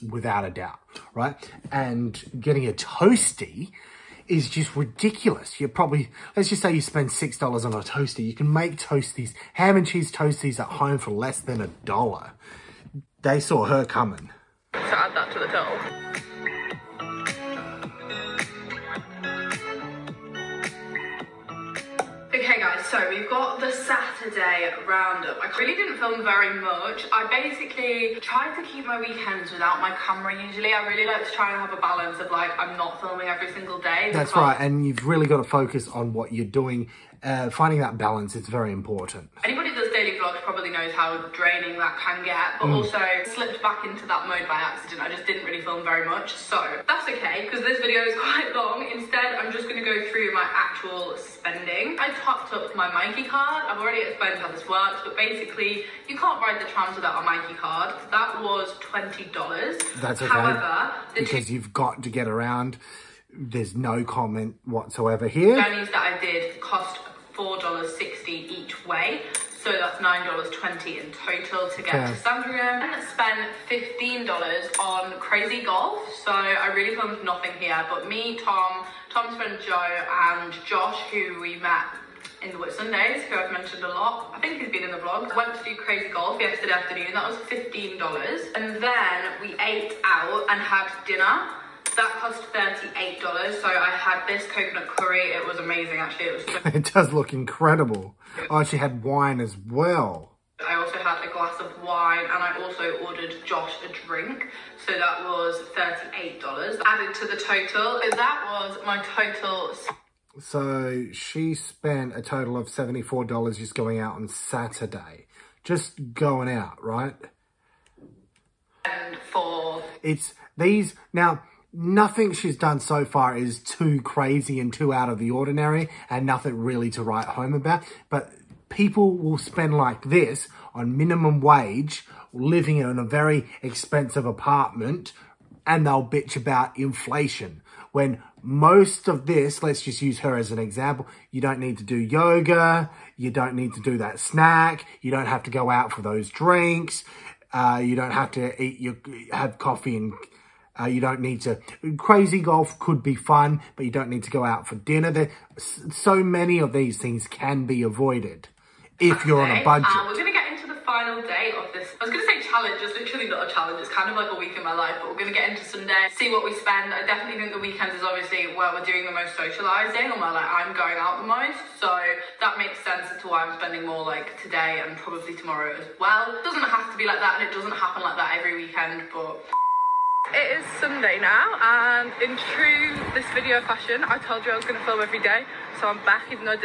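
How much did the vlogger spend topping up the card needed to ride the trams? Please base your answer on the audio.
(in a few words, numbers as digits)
$20.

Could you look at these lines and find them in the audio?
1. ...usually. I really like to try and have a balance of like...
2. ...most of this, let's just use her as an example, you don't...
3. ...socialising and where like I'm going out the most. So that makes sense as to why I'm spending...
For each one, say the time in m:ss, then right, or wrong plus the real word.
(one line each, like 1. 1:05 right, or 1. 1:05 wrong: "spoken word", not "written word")
1. 0:30 right
2. 2:18 right
3. 2:49 right.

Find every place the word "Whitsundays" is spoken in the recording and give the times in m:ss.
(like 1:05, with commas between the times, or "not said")
1:22.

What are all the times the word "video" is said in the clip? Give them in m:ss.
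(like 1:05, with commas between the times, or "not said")
0:47, 3:03.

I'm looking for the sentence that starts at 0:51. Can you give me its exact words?
I topped up my myki card.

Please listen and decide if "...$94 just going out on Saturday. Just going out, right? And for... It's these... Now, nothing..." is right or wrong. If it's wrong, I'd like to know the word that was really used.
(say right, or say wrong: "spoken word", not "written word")
wrong: "74", not "94".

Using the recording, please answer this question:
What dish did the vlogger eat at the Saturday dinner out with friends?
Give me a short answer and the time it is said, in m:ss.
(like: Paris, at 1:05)
coconut curry, at 1:34.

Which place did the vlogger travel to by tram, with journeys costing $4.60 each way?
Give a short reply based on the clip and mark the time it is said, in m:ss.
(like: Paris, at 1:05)
Sandringham, at 1:12.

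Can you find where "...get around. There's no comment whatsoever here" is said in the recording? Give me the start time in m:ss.
1:02.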